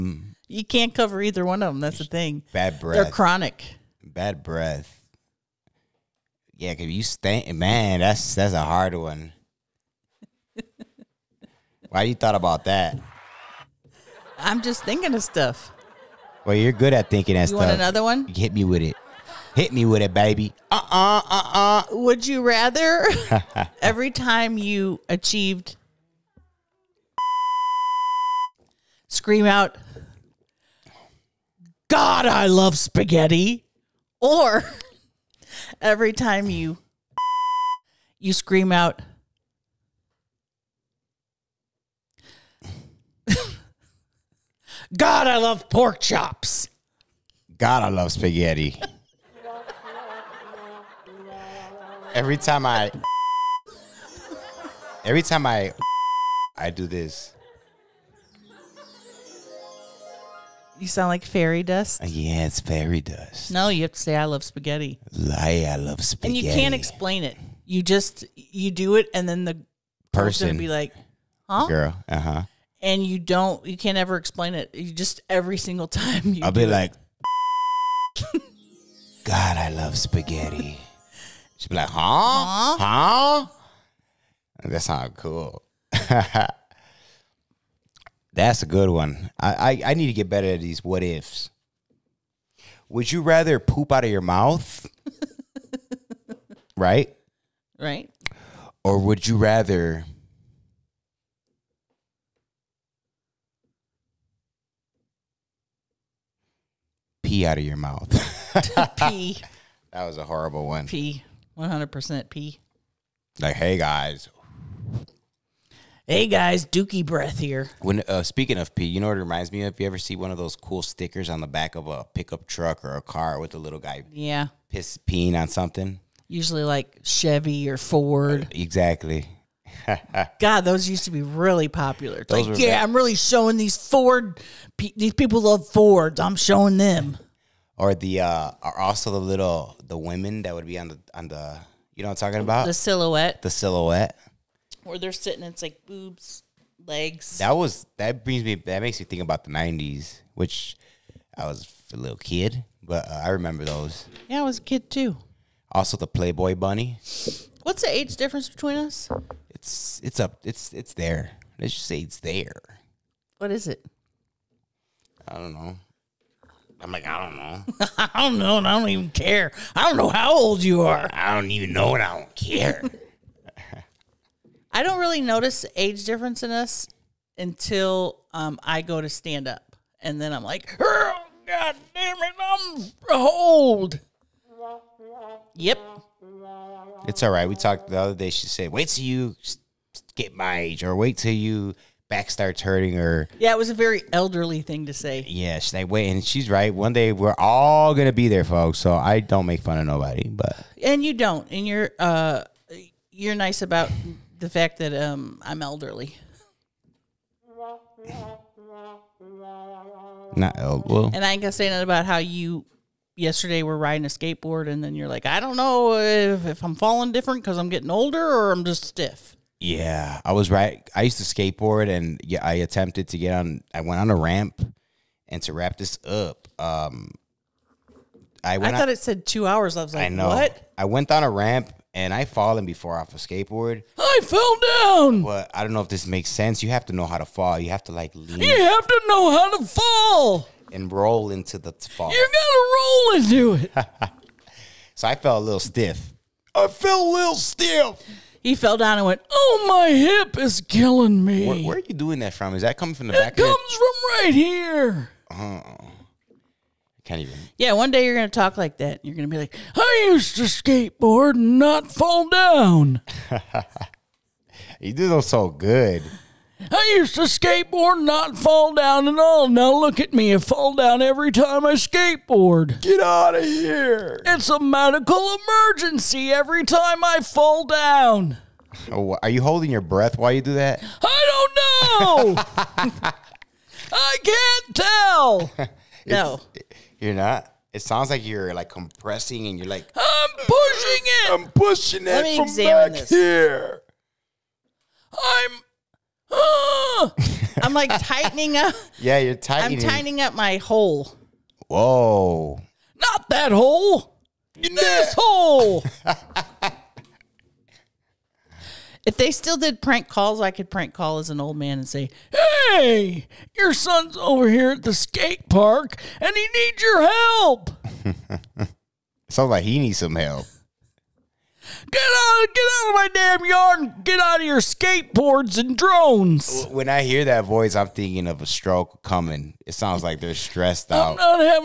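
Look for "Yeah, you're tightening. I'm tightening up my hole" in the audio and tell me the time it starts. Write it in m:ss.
4:58.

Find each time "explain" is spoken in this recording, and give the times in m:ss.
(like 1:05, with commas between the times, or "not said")
1:06, 1:14.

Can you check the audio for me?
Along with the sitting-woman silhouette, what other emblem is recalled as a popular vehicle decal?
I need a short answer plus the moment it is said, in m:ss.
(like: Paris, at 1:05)
Playboy Bunny, at 2:36.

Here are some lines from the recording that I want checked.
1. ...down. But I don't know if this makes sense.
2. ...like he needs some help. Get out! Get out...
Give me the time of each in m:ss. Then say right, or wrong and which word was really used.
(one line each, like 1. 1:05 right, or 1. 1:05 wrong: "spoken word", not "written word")
1. 3:54 right
2. 5:19 right.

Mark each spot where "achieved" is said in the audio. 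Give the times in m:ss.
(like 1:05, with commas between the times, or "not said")
0:25.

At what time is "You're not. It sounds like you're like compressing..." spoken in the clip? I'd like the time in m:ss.
4:47.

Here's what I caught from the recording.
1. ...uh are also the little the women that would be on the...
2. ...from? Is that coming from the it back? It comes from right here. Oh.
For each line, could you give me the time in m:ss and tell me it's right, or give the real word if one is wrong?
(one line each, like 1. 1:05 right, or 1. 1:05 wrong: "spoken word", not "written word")
1. 2:18 right
2. 4:12 right.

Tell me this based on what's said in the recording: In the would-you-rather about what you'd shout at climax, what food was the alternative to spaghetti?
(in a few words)
pork chops.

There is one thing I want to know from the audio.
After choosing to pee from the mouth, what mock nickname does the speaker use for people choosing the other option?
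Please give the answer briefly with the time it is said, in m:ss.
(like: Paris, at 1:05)
Dookie Breath, at 1:56.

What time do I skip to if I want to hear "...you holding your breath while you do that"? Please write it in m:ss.
4:39.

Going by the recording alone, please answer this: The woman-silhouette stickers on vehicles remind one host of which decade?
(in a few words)
the '90s.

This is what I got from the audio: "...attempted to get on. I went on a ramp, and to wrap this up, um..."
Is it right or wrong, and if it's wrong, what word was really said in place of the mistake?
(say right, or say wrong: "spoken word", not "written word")
right.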